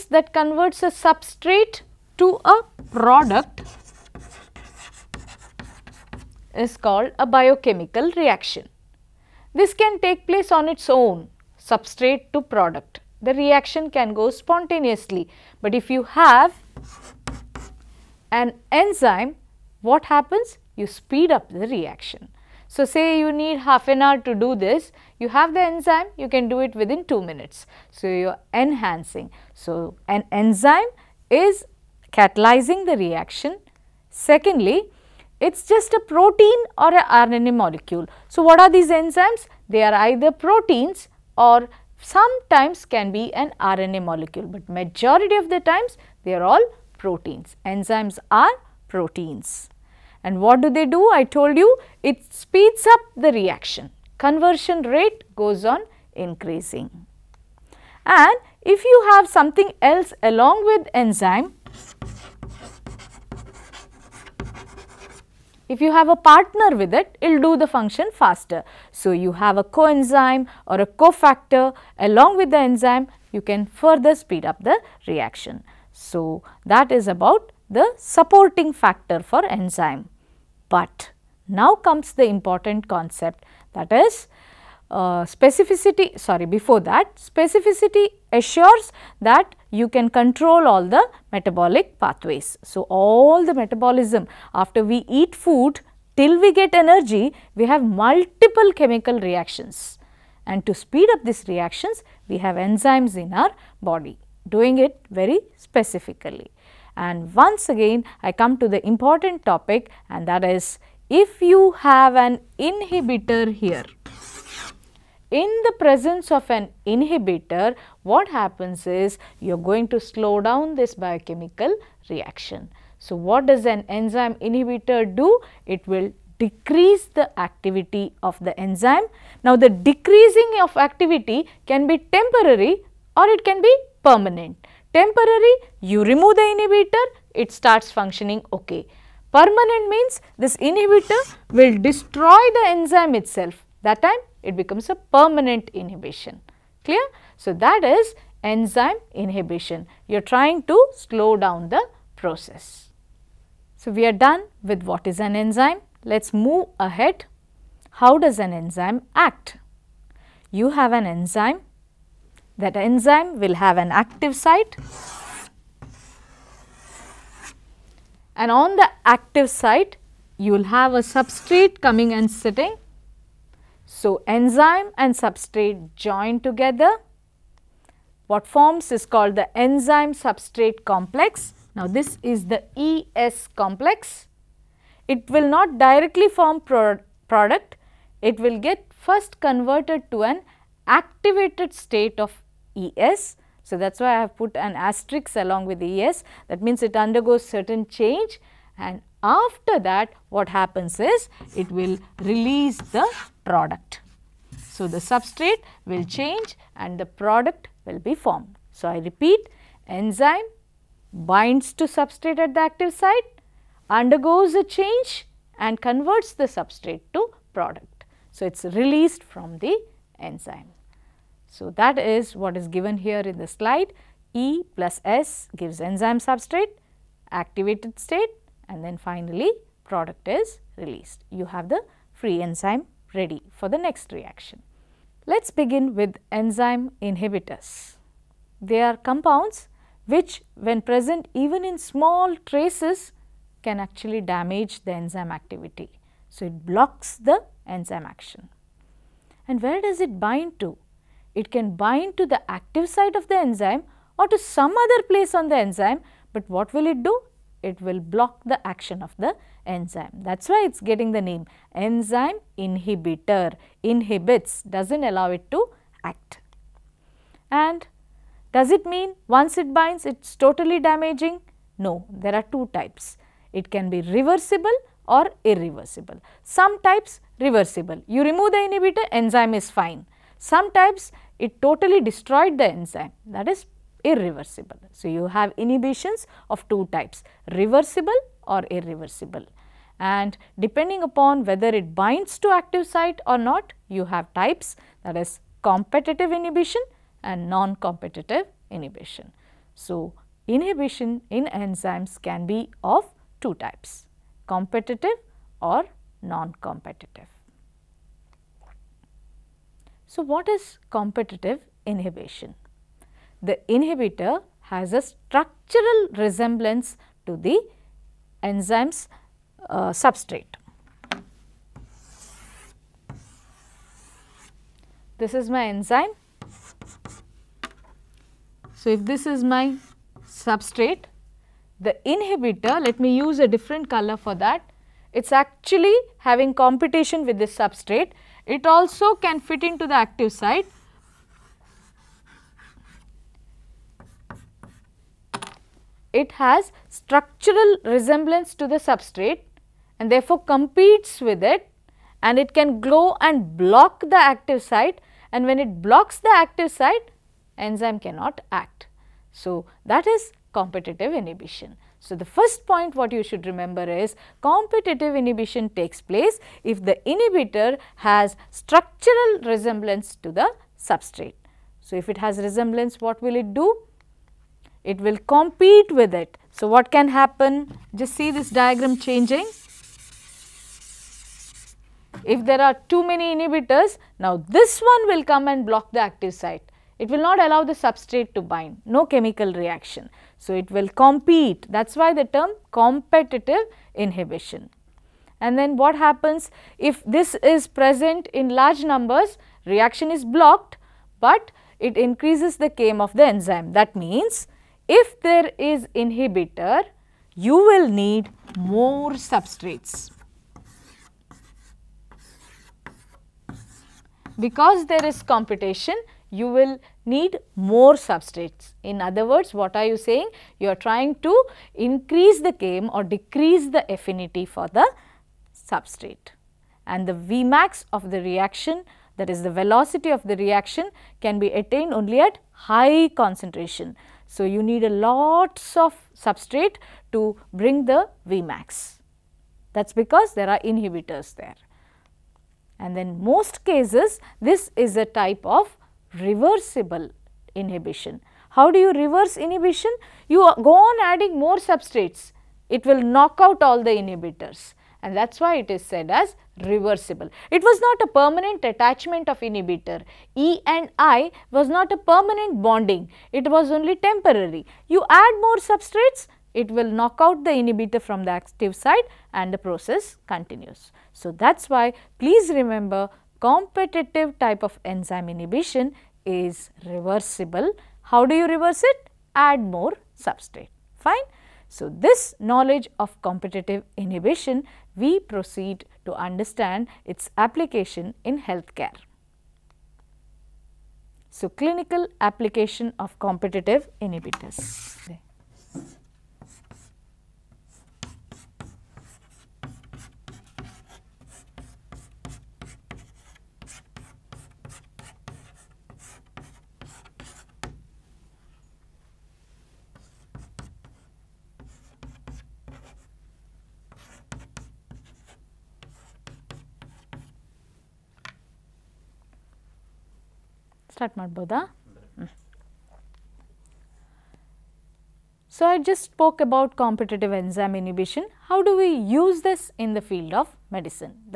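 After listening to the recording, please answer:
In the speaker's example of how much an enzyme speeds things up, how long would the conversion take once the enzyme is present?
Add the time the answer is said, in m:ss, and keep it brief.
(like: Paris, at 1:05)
2 minutes, at 0:27.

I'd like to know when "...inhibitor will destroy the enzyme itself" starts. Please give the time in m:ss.
2:20.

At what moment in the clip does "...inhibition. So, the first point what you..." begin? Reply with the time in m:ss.
6:01.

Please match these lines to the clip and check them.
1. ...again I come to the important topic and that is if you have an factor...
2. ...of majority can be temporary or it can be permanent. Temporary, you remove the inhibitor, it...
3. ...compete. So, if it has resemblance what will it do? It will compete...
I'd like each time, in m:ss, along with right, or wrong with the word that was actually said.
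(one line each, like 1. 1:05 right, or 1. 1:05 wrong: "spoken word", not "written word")
1. 1:47 wrong: "inhibitor", not "factor"
2. 2:10 wrong: "activity", not "majority"
3. 6:10 wrong: "substrate", not "compete".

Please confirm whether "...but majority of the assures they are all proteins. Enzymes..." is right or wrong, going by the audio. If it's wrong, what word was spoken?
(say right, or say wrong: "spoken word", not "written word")
wrong: "times", not "assures".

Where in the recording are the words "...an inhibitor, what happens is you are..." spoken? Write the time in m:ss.
1:56.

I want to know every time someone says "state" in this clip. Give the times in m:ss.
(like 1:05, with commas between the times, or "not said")
3:11, 3:48.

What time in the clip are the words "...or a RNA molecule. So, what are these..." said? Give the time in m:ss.
0:36.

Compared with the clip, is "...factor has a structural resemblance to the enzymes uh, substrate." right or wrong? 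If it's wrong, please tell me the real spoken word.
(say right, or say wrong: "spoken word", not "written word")
wrong: "inhibitor", not "factor".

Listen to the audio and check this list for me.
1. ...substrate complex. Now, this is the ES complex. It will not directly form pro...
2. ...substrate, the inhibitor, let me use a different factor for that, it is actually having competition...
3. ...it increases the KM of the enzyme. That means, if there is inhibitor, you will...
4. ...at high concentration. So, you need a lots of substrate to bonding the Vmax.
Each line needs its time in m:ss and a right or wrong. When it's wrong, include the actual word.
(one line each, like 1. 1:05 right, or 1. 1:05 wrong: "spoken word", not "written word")
1. 3:00 right
2. 5:30 wrong: "color", not "factor"
3. 6:41 right
4. 7:12 wrong: "bring", not "bonding".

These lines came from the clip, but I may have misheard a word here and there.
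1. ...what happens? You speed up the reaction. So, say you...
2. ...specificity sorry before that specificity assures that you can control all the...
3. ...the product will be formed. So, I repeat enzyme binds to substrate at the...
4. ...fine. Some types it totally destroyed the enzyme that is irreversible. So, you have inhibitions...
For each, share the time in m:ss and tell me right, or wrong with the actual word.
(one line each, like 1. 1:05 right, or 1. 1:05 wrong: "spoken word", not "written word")
1. 0:19 right
2. 1:25 right
3. 3:26 right
4. 4:39 right.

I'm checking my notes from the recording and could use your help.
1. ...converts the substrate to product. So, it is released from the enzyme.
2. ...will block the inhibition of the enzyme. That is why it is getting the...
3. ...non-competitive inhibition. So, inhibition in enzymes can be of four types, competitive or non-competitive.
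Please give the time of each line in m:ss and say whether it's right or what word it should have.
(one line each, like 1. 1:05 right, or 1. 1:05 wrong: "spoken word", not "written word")
1. 3:35 right
2. 4:17 wrong: "action", not "inhibition"
3. 4:57 wrong: "two", not "four".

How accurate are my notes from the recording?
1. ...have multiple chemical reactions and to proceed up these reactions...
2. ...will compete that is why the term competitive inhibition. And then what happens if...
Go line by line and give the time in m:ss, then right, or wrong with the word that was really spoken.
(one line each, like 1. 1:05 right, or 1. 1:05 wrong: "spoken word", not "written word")
1. 1:37 wrong: "speed", not "proceed"
2. 6:30 right.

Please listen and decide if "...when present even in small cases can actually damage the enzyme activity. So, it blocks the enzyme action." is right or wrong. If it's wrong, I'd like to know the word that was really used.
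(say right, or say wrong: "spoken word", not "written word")
wrong: "traces", not "cases".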